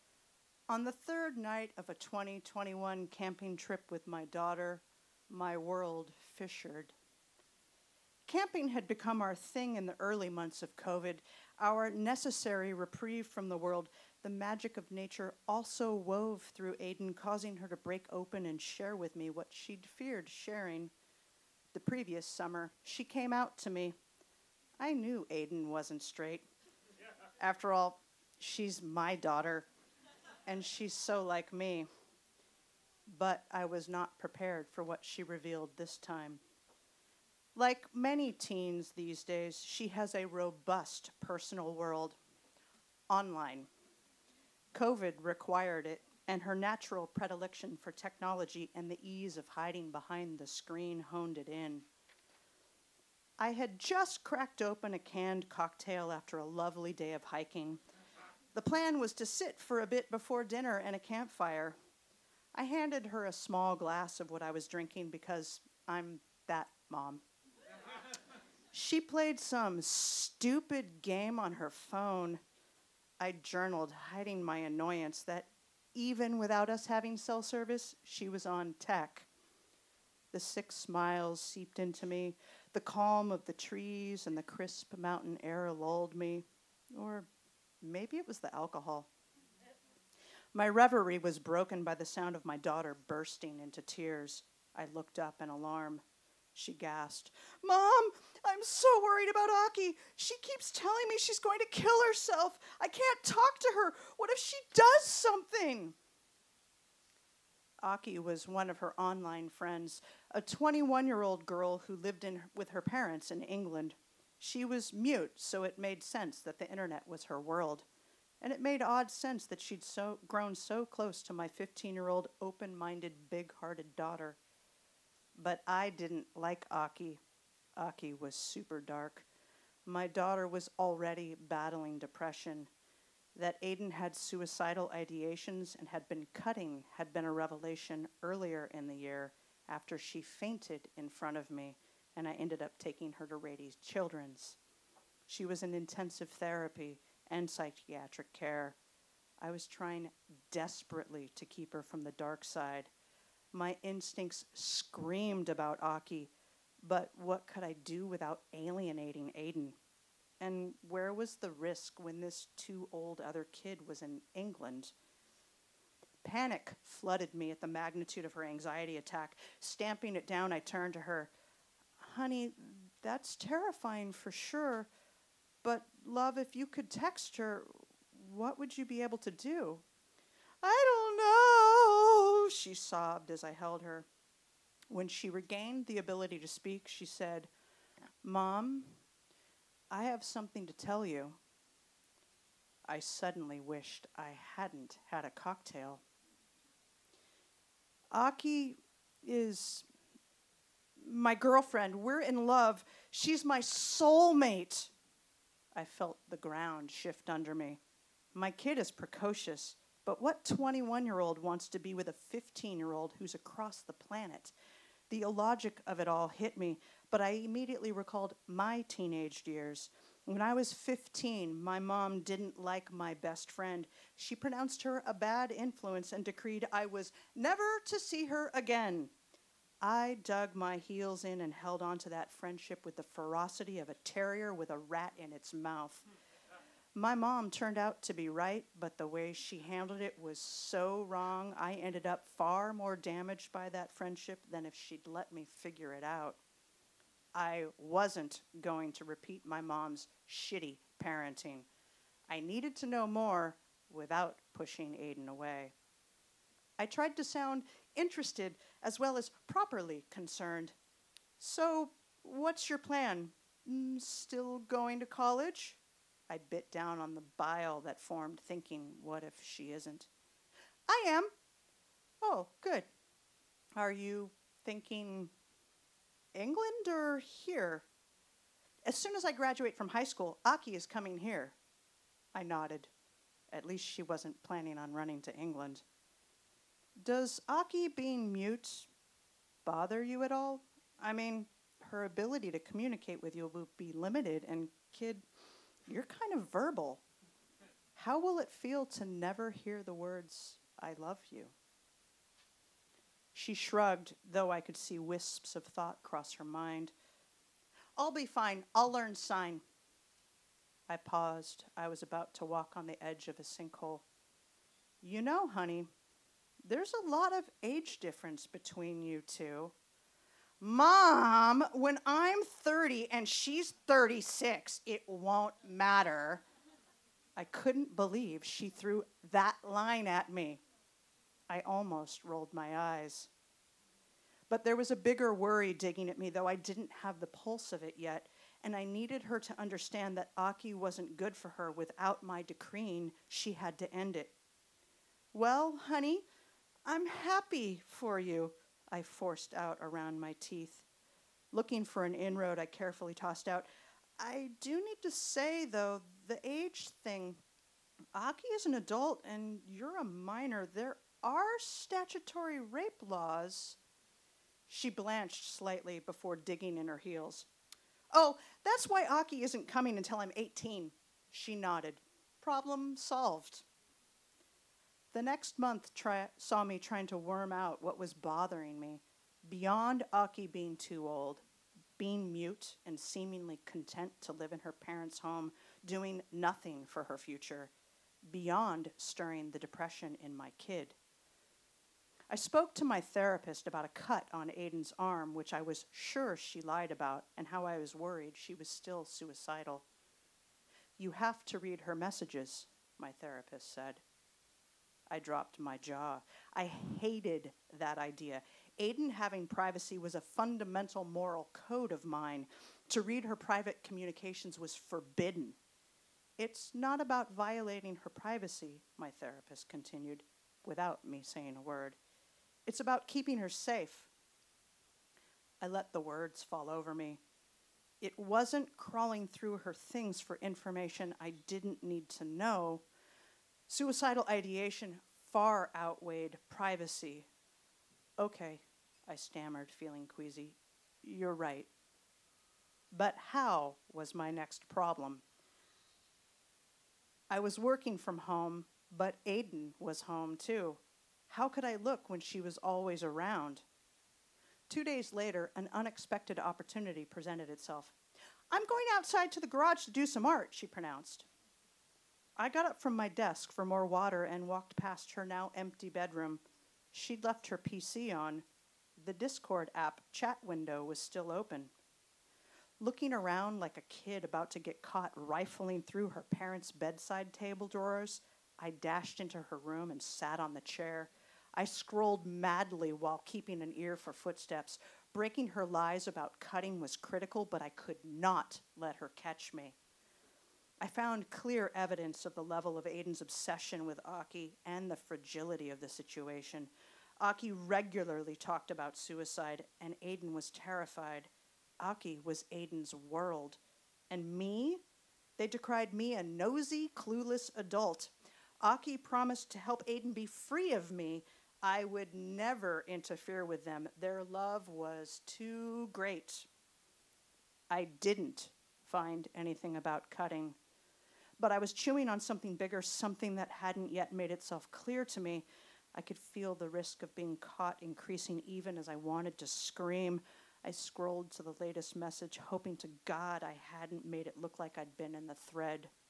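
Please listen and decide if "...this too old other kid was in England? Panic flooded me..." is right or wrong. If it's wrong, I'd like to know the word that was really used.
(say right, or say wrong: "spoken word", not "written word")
right.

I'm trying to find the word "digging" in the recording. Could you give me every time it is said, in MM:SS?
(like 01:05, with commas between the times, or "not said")
05:35, 06:06.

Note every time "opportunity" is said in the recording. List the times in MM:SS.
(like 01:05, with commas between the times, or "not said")
07:36.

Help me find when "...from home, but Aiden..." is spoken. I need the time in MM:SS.
07:27.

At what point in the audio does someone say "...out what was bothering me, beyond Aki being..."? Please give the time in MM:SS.
06:17.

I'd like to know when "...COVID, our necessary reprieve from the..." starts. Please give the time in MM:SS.
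00:10.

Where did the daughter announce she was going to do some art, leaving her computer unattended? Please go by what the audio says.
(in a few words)
the garage.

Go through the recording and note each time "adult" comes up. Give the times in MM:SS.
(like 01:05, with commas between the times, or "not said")
05:58, 08:27.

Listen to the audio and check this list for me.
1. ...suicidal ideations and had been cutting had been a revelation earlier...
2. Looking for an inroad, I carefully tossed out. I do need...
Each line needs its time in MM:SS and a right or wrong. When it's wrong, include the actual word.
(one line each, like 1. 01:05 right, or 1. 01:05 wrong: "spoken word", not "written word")
1. 02:14 right
2. 05:51 right.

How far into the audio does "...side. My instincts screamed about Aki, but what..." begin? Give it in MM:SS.
02:32.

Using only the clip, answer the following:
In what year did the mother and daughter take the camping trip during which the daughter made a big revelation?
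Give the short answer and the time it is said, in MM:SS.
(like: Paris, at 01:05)
2021, at 00:01.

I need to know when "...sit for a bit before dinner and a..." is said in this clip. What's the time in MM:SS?
00:59.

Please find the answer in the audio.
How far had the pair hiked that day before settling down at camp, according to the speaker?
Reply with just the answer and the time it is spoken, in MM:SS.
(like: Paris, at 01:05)
6 miles, at 01:20.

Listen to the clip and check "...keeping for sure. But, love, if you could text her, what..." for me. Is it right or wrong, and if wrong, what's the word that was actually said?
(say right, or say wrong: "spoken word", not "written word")
wrong: "terrifying", not "keeping".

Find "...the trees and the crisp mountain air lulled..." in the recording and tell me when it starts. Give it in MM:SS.
01:23.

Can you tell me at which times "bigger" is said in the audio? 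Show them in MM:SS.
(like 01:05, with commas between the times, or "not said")
05:34, 08:42.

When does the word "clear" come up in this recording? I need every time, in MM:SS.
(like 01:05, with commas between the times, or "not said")
08:11, 08:44.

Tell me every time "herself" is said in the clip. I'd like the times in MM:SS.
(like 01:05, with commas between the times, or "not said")
01:42.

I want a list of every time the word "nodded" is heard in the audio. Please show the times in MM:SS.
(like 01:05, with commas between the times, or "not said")
04:42, 06:11.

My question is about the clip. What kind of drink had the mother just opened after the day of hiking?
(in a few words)
canned cocktail.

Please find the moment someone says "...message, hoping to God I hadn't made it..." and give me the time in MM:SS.
08:51.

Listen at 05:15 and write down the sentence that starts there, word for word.
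You know, honey, there's a lot of age difference between you two.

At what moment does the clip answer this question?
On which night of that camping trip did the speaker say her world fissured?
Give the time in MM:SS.
00:01.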